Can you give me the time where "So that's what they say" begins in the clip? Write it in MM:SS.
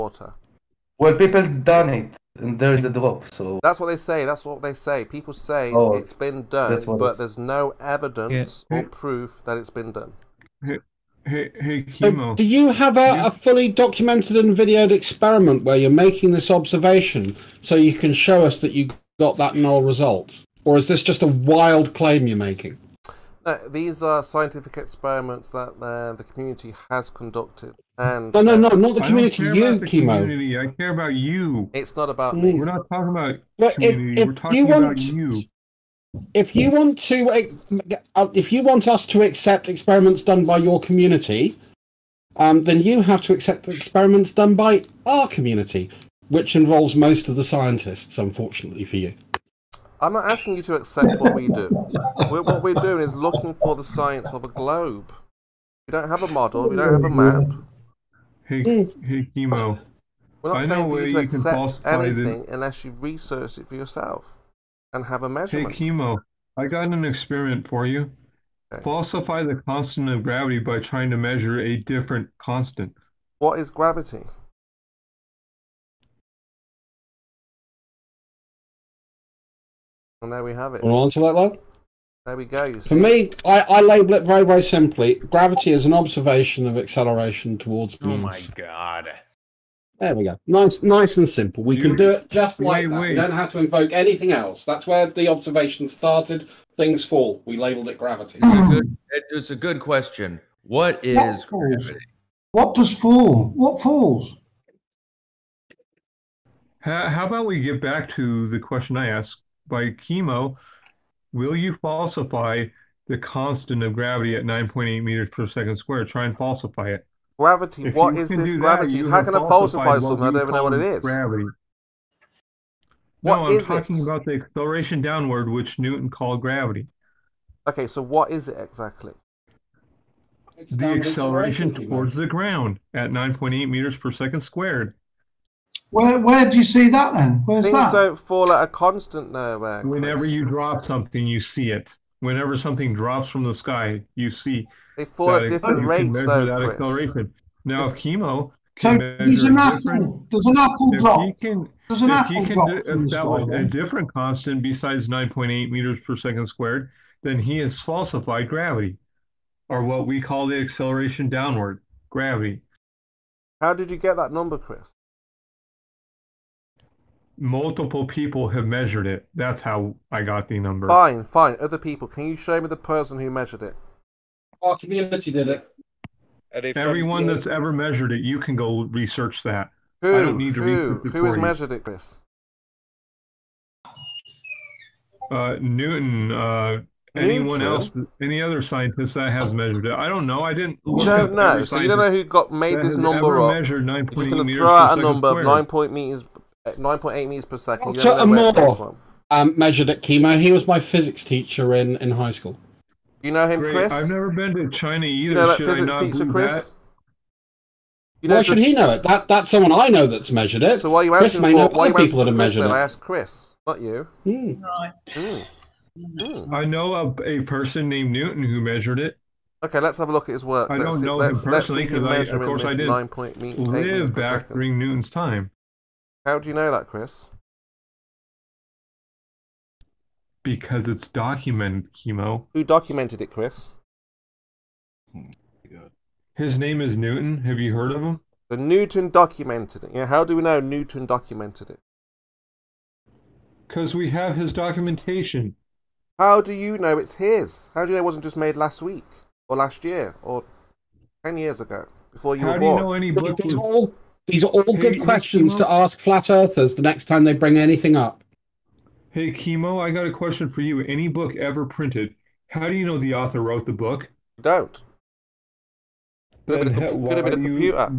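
00:03.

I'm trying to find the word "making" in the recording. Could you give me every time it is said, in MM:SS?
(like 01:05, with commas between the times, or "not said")
00:15, 00:22.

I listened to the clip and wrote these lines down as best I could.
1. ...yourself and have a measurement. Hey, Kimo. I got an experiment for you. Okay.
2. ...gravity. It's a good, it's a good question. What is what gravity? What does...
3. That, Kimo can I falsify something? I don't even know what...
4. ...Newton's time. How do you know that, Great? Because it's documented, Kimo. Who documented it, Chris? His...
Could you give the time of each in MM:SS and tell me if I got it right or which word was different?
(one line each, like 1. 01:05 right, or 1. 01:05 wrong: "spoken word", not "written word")
1. 01:03 right
2. 01:37 right
3. 01:59 wrong: "How", not "Kimo"
4. 03:44 wrong: "Chris", not "Great".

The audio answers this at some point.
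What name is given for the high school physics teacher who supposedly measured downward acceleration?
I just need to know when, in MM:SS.
03:17.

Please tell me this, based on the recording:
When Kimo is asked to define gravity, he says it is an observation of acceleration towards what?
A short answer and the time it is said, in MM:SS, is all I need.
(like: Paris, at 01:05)
moons, at 01:27.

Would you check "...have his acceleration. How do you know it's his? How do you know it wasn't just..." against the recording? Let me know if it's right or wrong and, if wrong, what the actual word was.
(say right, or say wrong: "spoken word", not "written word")
wrong: "documentation", not "acceleration".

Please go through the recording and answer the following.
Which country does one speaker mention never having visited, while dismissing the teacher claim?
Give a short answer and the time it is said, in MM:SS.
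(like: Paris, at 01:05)
China, at 03:24.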